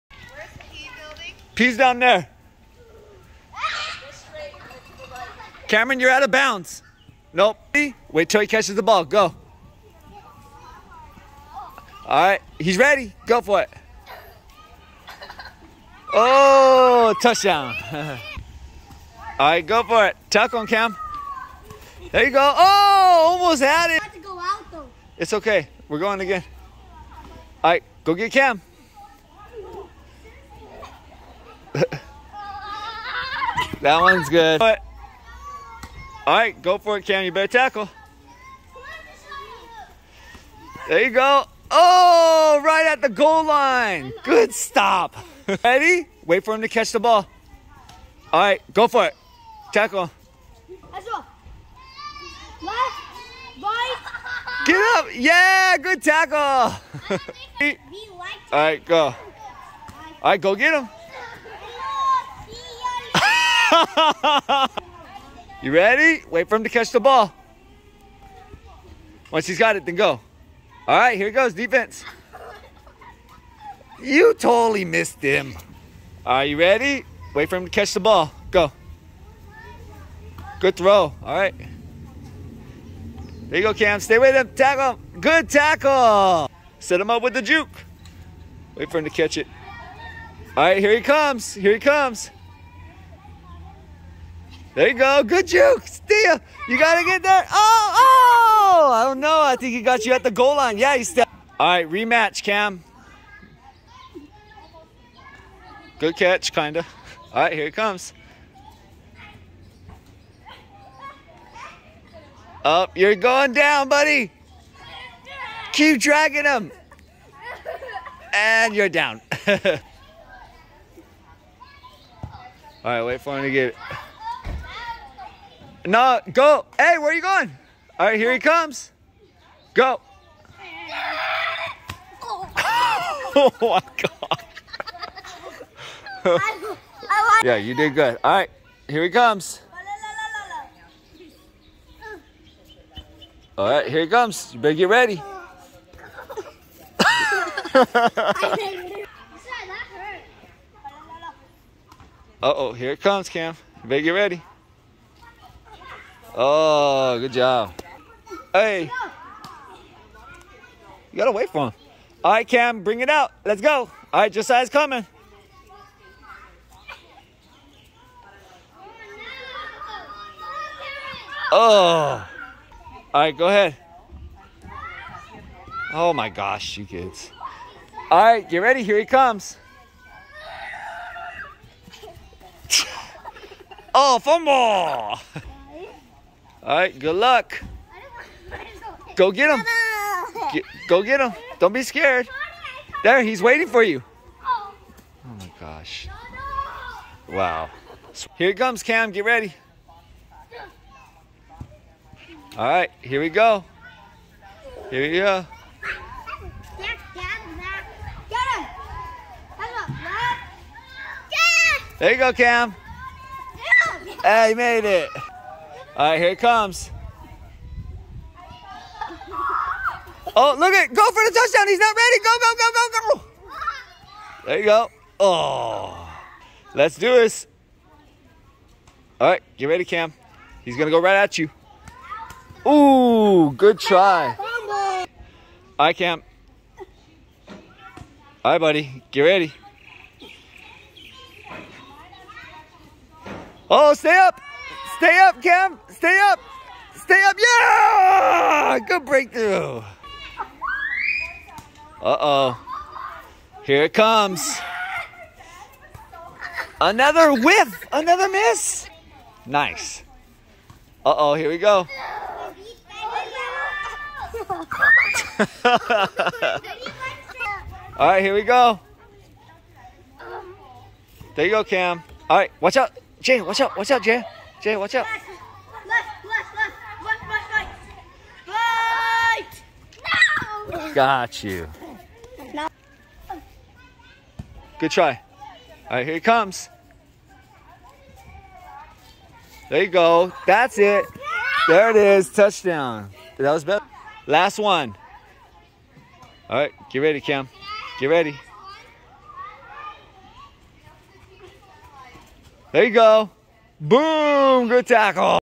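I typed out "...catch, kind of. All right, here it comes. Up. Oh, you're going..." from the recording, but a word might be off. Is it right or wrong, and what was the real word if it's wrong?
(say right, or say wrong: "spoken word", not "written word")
right.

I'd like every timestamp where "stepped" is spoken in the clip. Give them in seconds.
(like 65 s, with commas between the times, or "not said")
101 s.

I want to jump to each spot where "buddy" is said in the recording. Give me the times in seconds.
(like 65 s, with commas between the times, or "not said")
113 s, 238 s.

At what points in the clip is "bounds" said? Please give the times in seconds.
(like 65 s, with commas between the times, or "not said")
6 s.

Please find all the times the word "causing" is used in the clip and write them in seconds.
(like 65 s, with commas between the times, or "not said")
not said.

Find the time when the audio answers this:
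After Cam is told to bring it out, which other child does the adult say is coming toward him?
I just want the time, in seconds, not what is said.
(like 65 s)
164 s.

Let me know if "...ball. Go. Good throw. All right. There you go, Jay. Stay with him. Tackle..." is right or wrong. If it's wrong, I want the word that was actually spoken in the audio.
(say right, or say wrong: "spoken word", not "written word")
wrong: "Cam", not "Jay".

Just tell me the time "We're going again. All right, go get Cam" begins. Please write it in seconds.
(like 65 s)
25 s.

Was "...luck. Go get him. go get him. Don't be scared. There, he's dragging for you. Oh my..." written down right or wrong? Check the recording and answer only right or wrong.
wrong.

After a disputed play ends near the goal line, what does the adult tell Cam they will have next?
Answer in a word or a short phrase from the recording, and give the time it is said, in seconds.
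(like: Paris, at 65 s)
Rematch, at 101 s.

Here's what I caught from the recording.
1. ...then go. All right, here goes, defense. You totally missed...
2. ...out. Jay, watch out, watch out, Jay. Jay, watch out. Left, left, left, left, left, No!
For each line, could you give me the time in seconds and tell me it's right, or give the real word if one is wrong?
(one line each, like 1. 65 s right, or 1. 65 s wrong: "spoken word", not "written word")
1. 69 s right
2. 272 s right.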